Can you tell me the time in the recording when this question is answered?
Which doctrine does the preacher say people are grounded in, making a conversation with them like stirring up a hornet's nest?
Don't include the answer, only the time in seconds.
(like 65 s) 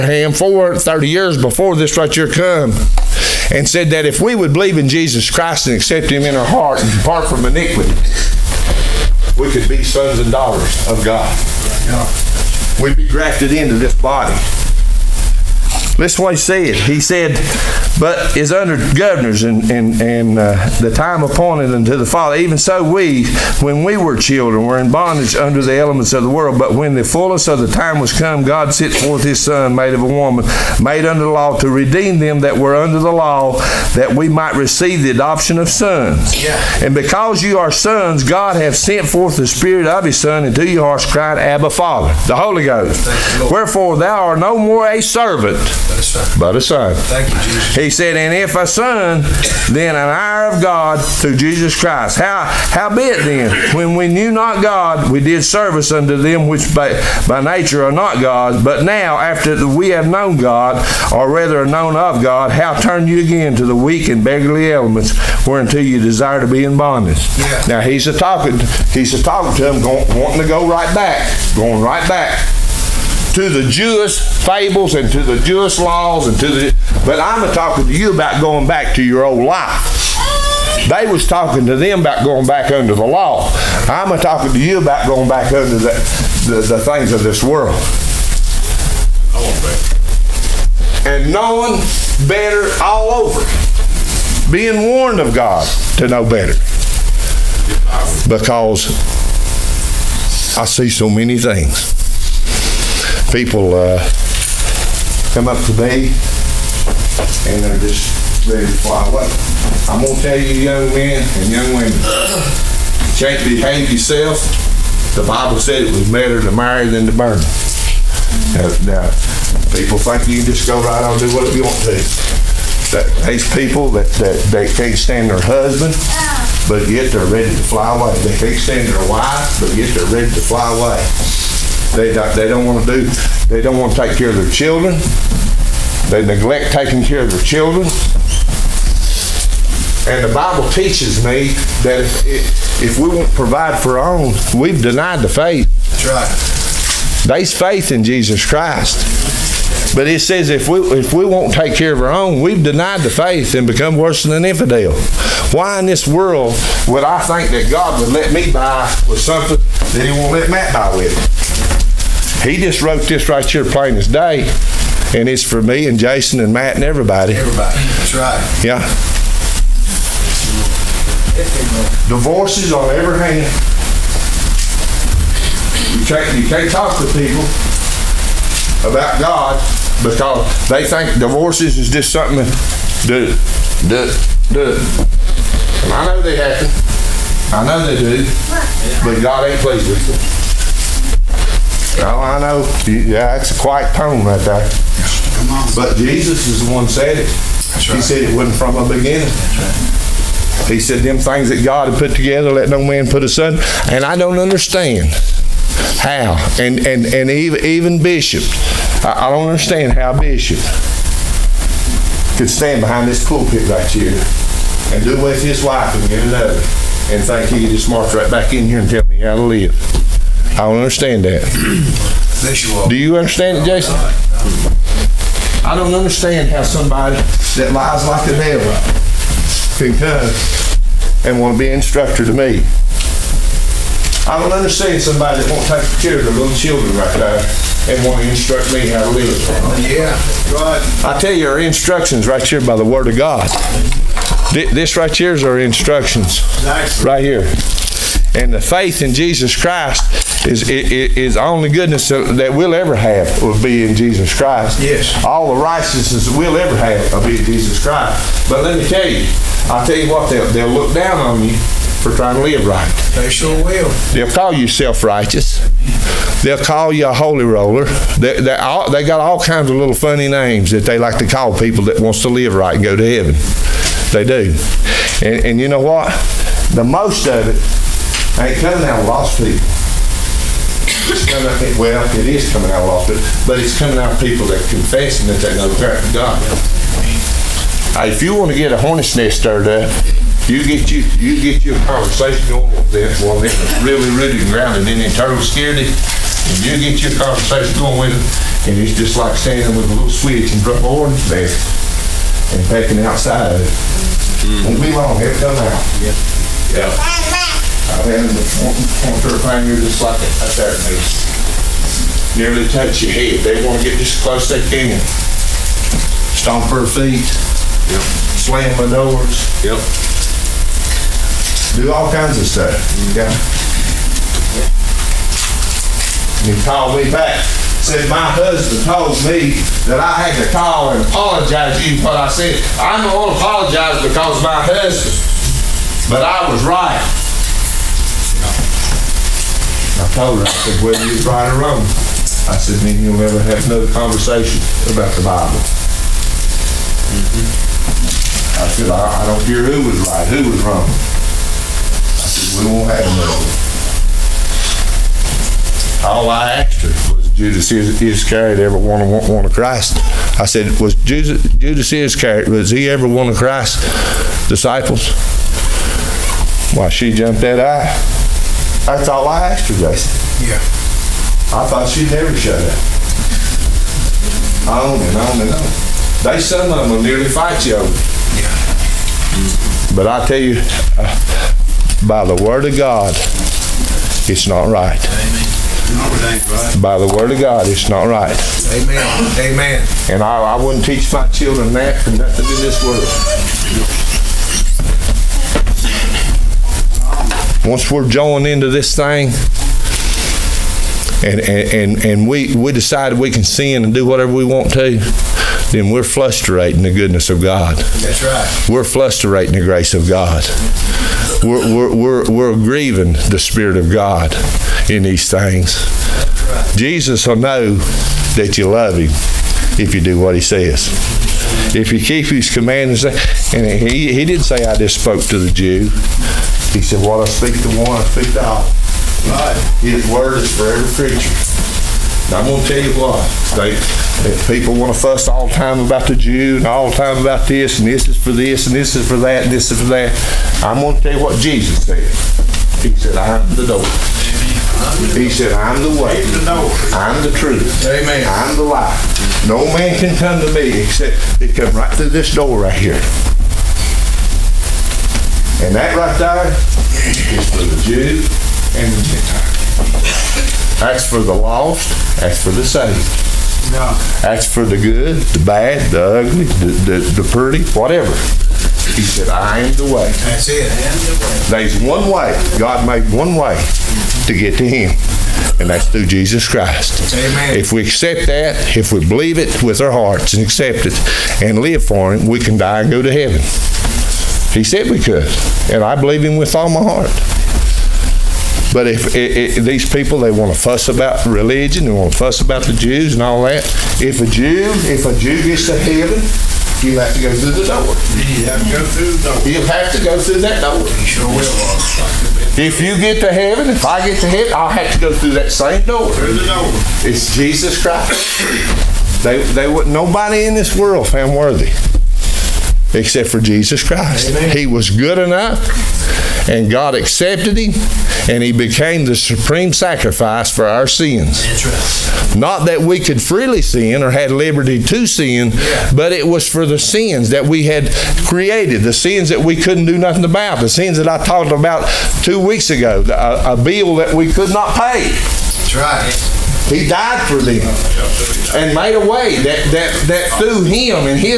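295 s.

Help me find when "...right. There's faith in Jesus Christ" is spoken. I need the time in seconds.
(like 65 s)
146 s.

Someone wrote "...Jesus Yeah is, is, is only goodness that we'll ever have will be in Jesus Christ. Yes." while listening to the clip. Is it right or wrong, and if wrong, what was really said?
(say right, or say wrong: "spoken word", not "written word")
wrong: "Christ", not "Yeah".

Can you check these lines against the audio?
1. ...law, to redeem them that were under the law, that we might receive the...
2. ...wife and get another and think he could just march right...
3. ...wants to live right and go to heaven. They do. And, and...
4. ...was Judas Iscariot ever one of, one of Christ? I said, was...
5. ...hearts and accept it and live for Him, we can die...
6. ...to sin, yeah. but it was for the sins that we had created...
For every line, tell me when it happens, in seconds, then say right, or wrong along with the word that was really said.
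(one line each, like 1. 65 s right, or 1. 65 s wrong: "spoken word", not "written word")
1. 31 s right
2. 215 s right
3. 272 s right
4. 357 s right
5. 479 s right
6. 524 s right.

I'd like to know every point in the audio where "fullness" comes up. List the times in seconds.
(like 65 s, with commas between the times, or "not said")
27 s.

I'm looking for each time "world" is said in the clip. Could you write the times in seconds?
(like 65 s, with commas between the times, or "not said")
26 s, 87 s, 156 s, 392 s, 510 s.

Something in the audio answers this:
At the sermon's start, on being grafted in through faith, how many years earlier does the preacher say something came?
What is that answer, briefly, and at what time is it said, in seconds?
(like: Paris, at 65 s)
430 years, at 0 s.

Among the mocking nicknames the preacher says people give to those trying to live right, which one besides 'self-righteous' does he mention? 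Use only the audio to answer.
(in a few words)
holy roller.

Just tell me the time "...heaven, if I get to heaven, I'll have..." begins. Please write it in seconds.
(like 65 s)
503 s.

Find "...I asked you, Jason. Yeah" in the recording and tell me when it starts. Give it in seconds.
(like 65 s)
369 s.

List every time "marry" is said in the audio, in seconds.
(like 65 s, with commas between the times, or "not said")
116 s.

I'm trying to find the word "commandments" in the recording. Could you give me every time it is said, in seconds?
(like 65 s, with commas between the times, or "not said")
422 s.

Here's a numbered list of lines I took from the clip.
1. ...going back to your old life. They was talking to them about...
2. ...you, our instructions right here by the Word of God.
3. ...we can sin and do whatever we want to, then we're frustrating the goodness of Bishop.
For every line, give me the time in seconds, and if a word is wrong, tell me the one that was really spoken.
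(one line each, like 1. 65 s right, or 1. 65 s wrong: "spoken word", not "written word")
1. 78 s right
2. 241 s right
3. 403 s wrong: "God", not "Bishop".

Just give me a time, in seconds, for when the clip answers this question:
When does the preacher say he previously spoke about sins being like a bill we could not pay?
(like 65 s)
532 s.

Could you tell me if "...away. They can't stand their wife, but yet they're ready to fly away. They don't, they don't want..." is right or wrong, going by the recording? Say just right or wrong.
right.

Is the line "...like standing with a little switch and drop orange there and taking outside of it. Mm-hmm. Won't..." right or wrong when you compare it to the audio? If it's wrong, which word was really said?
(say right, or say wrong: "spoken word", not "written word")
right.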